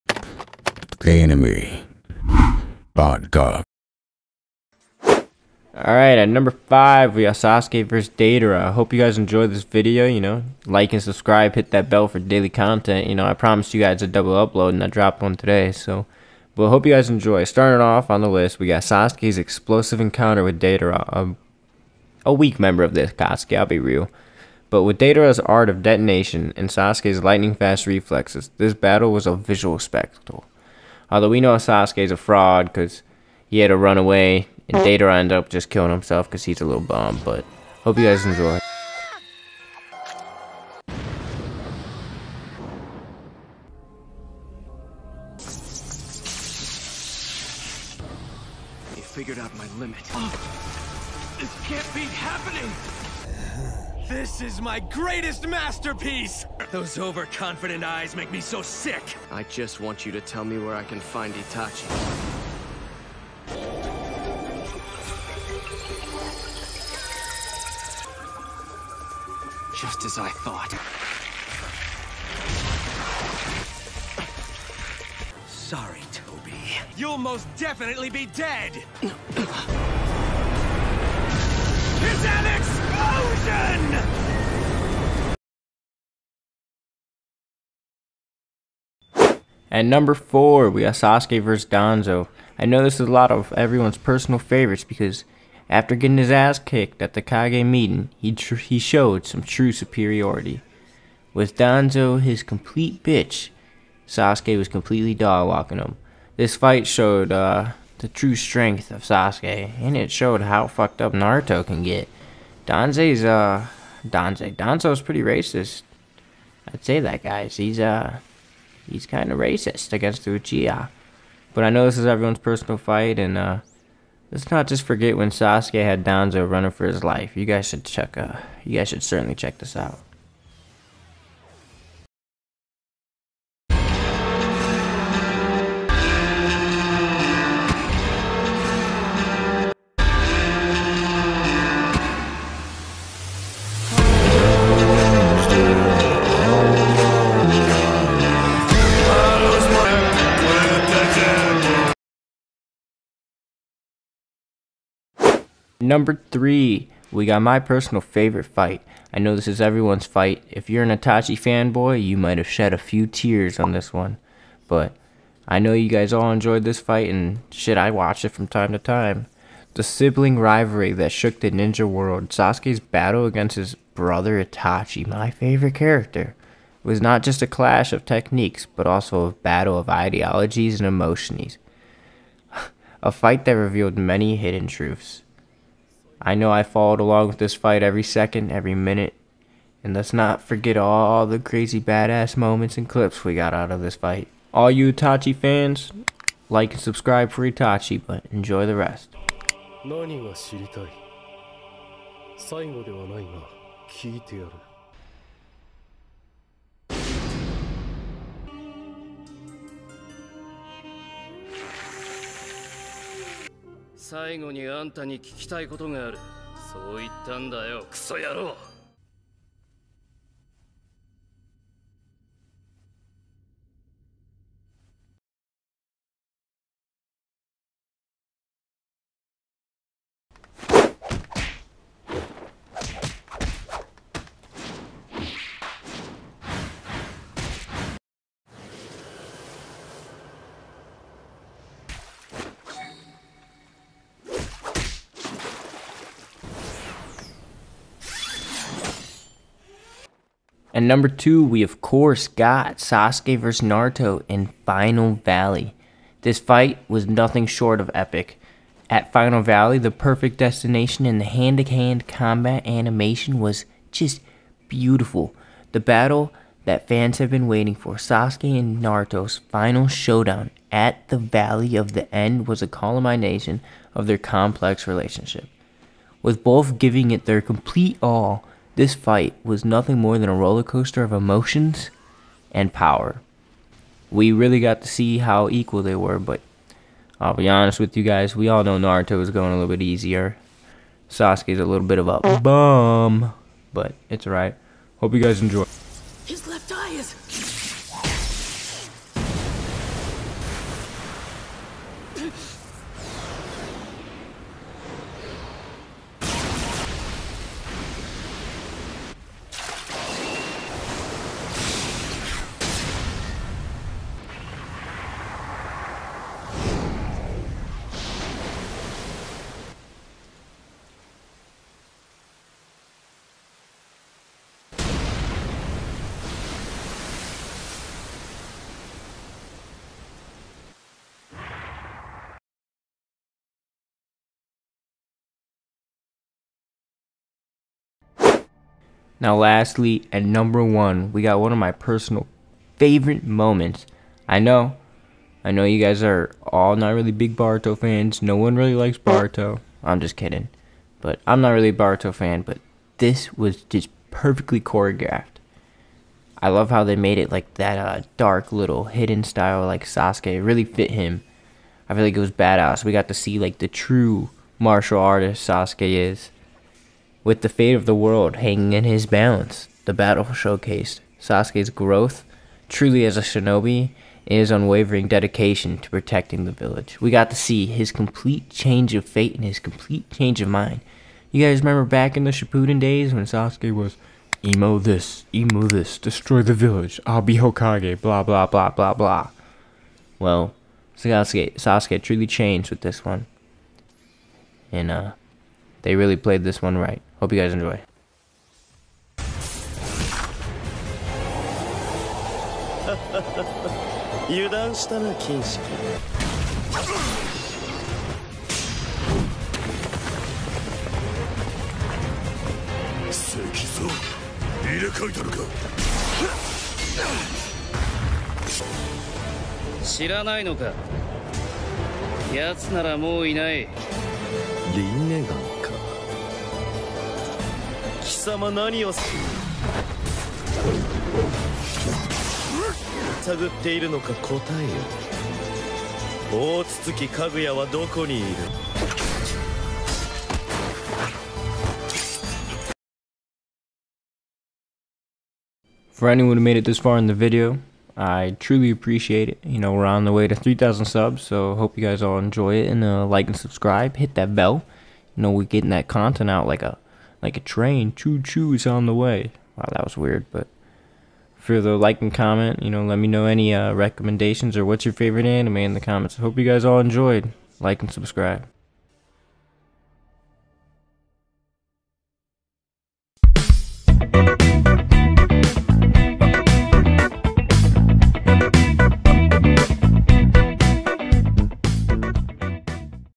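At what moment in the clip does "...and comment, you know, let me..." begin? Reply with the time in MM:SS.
07:42.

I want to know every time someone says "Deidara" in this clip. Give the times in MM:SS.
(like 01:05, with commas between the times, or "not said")
00:08, 00:20, 00:24.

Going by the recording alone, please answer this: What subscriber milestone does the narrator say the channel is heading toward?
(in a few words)
3,000 subs.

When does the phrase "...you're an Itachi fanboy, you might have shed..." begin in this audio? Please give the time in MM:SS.
02:40.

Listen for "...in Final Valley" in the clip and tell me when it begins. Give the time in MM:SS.
04:14.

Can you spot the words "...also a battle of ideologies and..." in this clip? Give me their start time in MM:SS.
02:58.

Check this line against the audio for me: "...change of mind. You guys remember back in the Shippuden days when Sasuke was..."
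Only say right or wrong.
right.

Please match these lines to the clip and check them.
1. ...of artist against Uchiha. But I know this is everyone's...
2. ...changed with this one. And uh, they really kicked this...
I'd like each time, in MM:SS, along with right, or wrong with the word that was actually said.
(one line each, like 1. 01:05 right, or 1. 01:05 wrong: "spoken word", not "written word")
1. 01:59 wrong: "racist", not "artist"
2. 06:32 wrong: "played", not "kicked".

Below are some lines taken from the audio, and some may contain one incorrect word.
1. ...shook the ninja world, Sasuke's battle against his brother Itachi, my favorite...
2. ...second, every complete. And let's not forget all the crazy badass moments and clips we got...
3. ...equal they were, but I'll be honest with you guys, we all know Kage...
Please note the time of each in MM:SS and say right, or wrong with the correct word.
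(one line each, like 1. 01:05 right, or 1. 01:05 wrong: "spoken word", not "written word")
1. 02:51 right
2. 03:08 wrong: "minute", not "complete"
3. 04:45 wrong: "Naruto", not "Kage".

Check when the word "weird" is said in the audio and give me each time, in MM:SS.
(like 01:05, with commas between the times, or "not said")
07:39.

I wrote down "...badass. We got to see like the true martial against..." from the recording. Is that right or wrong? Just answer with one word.
wrong.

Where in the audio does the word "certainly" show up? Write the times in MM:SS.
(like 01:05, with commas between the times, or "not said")
02:09.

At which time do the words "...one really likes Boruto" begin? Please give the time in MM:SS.
05:48.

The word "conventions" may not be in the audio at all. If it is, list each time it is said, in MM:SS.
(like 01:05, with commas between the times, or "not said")
not said.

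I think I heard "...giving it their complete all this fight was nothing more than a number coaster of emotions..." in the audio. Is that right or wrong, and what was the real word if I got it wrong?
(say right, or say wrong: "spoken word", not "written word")
wrong: "roller", not "number".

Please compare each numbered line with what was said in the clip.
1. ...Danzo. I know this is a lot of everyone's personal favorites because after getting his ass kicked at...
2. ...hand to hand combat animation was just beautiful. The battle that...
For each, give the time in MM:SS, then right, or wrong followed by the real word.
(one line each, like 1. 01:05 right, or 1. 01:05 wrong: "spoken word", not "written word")
1. 01:31 right
2. 04:21 right.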